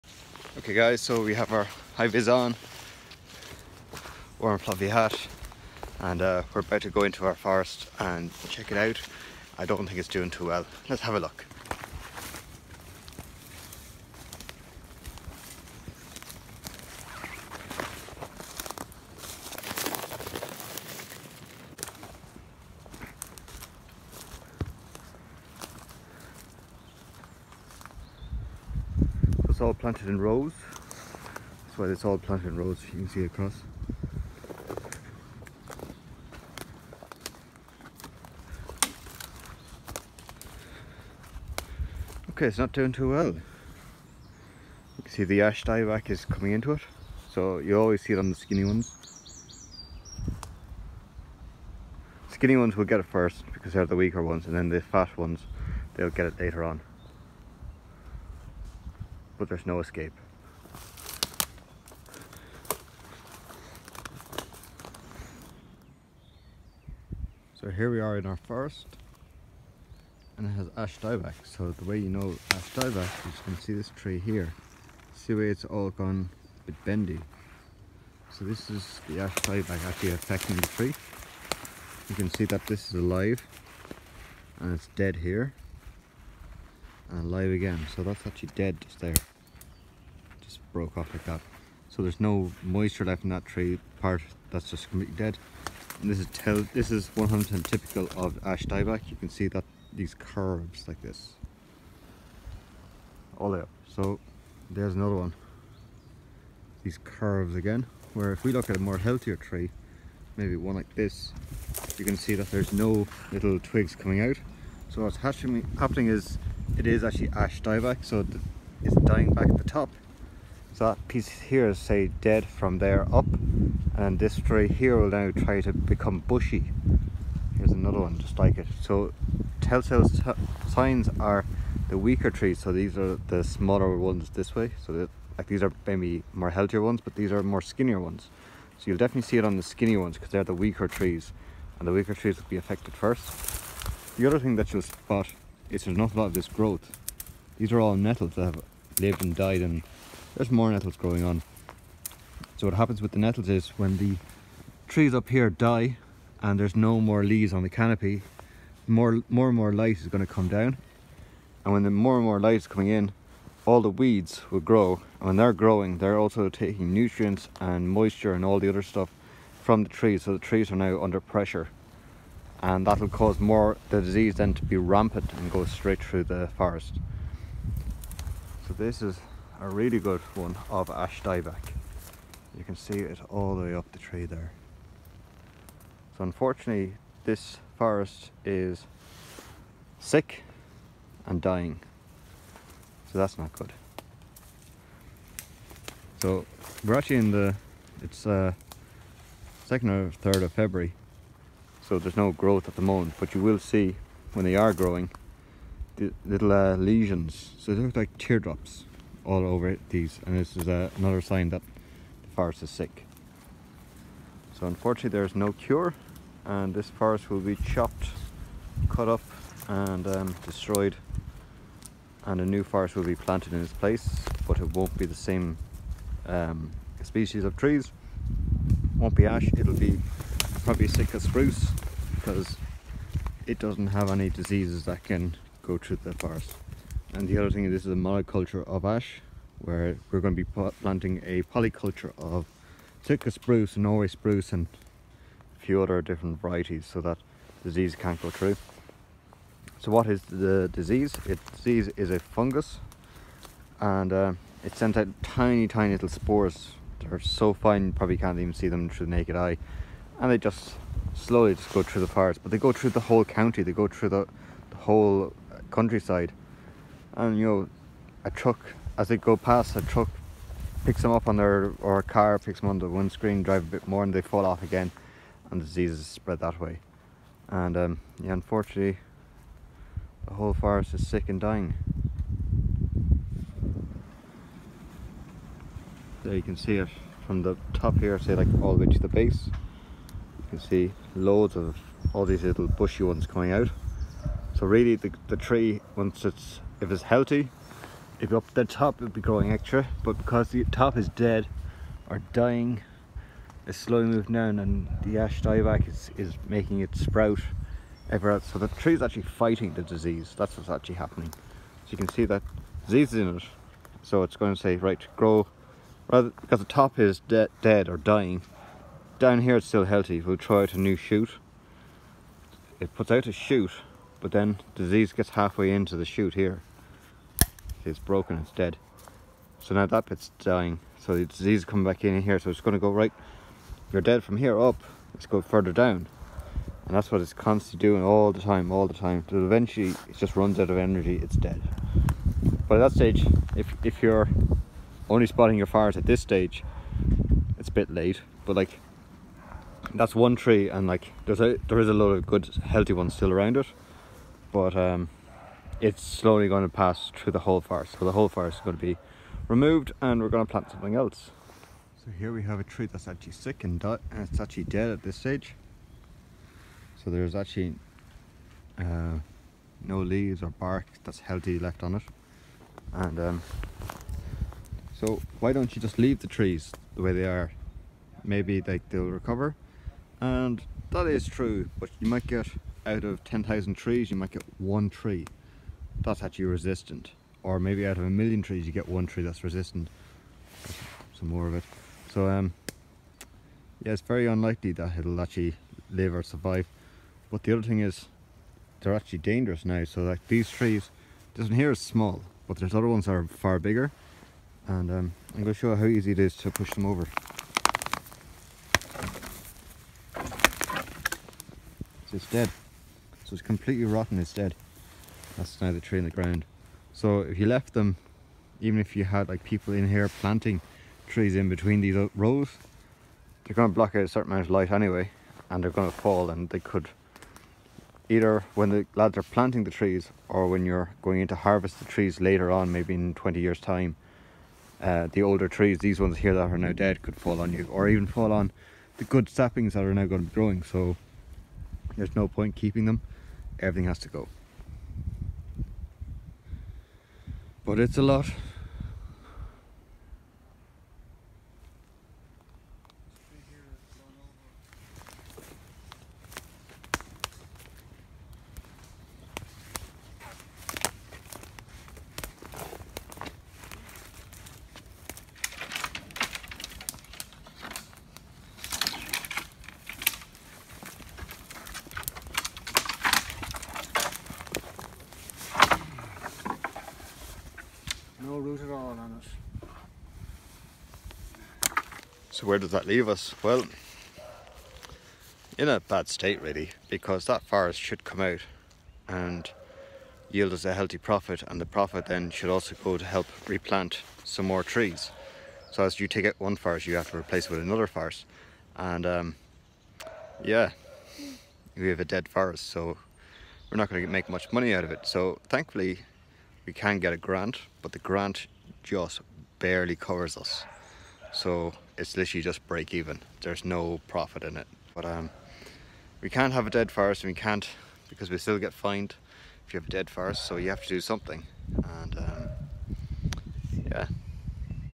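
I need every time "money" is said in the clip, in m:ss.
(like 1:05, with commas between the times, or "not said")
8:24.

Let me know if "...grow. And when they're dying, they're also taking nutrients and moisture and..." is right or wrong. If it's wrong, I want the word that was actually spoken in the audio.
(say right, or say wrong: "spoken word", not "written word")
wrong: "growing", not "dying".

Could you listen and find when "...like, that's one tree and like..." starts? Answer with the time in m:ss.
5:48.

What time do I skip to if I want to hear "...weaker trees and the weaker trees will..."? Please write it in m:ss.
2:20.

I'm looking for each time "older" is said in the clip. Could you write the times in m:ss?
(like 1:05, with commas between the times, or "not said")
7:15.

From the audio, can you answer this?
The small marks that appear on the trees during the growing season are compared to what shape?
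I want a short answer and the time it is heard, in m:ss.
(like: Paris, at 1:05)
Teardrops, at 3:28.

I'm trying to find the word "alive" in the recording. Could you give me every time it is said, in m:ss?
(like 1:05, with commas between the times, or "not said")
1:22, 1:27.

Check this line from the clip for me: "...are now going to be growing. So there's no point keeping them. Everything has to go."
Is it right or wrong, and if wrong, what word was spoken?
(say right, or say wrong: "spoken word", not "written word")
right.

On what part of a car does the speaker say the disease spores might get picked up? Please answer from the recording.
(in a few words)
Windscreen.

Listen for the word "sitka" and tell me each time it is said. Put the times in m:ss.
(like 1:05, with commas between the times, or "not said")
3:50, 4:03.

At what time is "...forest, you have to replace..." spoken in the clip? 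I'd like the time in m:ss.
8:16.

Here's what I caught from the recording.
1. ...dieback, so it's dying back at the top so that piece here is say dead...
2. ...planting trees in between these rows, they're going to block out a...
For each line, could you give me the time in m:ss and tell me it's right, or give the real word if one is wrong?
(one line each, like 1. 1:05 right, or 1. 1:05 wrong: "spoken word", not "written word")
1. 1:57 right
2. 7:00 right.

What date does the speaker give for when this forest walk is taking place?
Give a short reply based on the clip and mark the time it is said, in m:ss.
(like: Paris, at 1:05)
2nd or 3rd of February, at 3:19.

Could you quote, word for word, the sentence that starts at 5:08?
So the tree is actually fighting the disease.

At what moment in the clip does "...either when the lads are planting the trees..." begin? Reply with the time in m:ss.
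7:08.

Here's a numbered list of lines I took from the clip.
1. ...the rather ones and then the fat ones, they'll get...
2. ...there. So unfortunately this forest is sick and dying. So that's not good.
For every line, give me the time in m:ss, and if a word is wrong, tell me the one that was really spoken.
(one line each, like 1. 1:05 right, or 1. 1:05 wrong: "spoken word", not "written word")
1. 0:53 wrong: "weaker", not "rather"
2. 3:04 right.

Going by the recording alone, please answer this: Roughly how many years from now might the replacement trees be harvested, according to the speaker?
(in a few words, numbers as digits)
20 years.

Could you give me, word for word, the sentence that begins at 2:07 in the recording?
Here's another one just like it.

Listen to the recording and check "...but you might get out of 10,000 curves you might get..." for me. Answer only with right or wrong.
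wrong.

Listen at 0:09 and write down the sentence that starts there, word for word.
I don't think it's doing too well.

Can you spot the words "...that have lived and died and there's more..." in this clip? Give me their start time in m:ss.
2:28.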